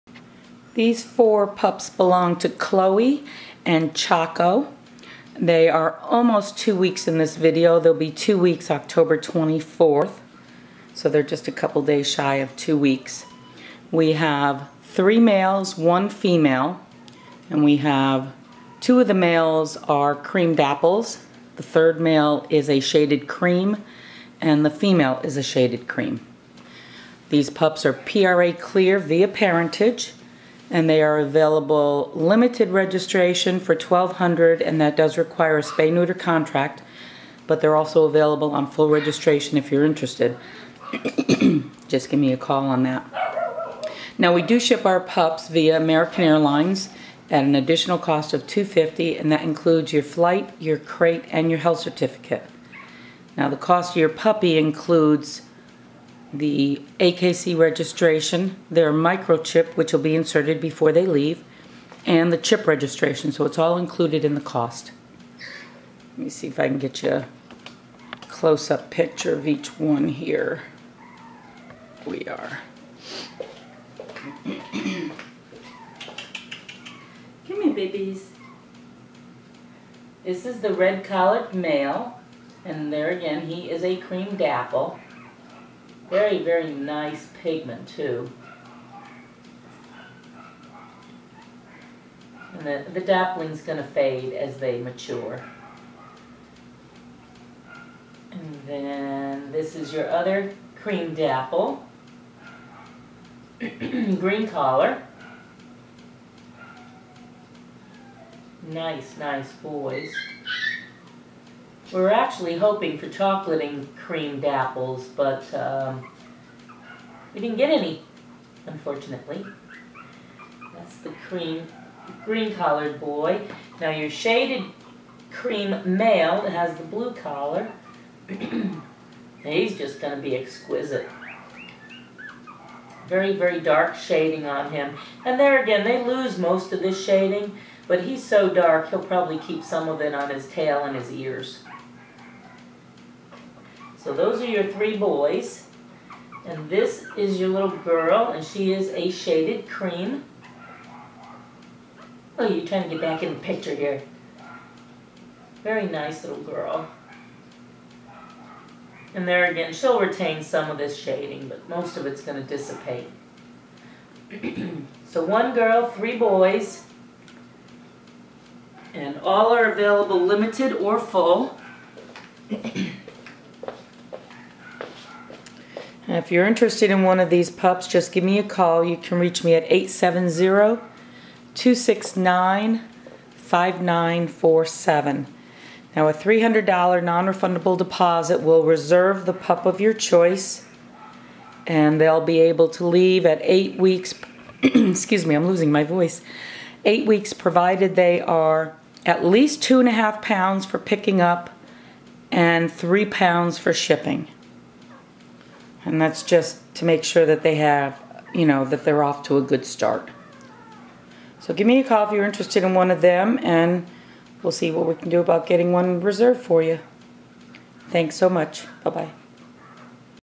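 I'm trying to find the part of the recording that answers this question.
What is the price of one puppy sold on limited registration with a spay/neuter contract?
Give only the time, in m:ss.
0:33.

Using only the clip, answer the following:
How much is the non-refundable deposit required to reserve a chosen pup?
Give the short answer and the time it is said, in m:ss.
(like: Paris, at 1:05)
$300, at 3:06.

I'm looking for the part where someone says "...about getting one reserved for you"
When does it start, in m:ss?
3:35.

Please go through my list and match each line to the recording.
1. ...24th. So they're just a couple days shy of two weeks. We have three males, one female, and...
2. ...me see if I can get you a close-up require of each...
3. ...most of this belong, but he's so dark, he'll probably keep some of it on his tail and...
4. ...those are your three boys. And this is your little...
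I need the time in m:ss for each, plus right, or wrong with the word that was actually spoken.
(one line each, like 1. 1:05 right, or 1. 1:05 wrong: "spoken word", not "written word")
1. 0:09 right
2. 1:06 wrong: "picture", not "require"
3. 2:16 wrong: "shading", not "belong"
4. 2:24 right.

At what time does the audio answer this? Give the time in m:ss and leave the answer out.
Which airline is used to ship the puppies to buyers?
0:45.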